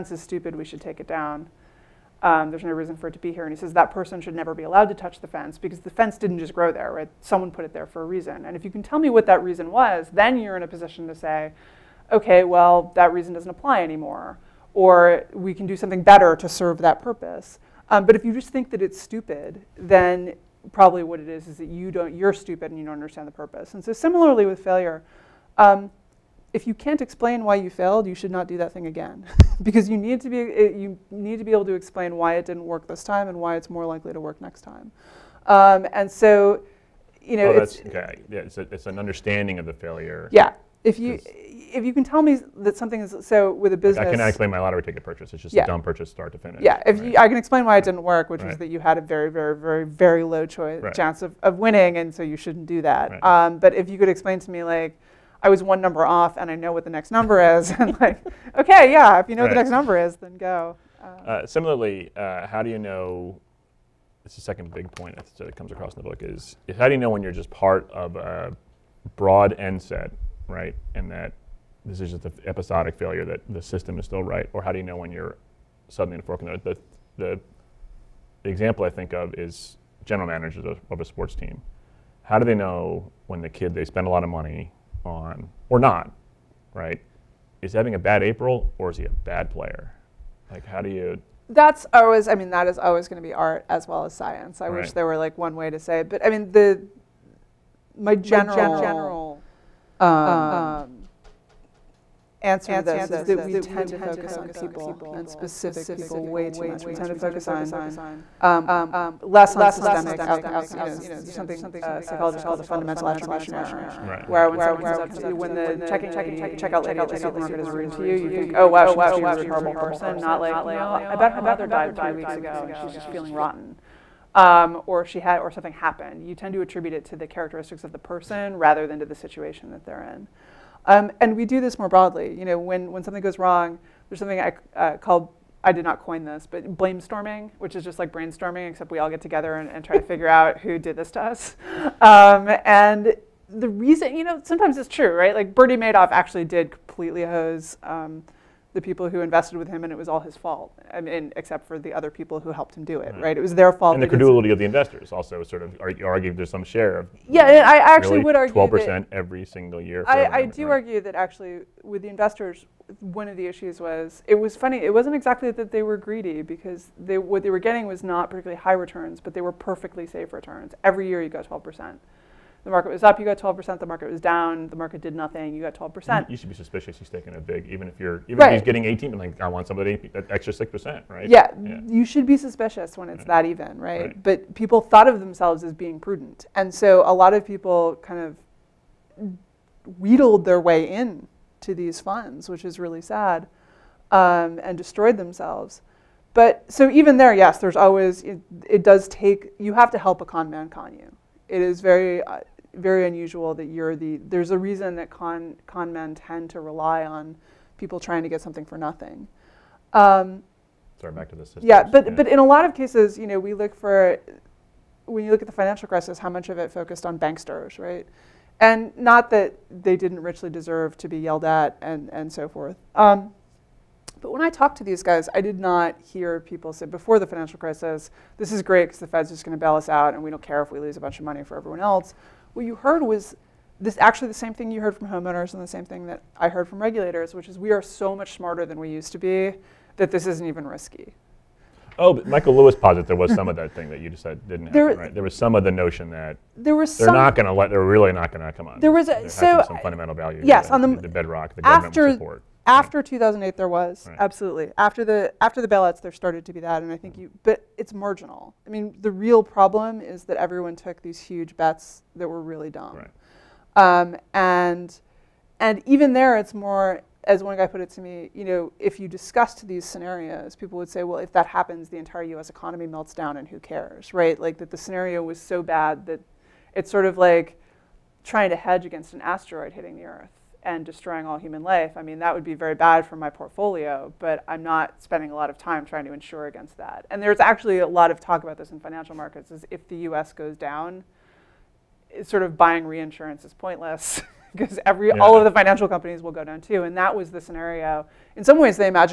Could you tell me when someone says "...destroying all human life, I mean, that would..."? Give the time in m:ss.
4:40.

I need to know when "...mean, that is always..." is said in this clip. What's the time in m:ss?
1:32.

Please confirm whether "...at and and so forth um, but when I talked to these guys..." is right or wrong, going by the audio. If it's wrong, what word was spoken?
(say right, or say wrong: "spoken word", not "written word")
right.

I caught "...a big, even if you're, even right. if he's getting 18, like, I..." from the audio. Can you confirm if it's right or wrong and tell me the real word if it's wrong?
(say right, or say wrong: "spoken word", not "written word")
right.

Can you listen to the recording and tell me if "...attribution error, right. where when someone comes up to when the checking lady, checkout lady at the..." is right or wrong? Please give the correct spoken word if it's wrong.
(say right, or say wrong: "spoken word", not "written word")
right.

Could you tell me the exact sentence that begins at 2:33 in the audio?
And the credulity of the investors also sort of argue, argue there's some share of.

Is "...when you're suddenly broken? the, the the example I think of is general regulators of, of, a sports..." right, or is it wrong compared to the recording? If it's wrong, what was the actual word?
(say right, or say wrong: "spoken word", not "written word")
wrong: "managers", not "regulators".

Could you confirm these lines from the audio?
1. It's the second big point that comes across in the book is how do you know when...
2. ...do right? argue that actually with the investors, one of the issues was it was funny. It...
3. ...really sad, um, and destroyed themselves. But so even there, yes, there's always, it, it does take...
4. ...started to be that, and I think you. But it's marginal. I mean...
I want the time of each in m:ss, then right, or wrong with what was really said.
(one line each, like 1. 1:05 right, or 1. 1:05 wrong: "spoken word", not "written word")
1. 1:04 right
2. 2:40 right
3. 3:12 right
4. 4:16 right.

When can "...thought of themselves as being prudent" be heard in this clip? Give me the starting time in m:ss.
3:04.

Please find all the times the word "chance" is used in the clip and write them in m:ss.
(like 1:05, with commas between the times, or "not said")
0:50.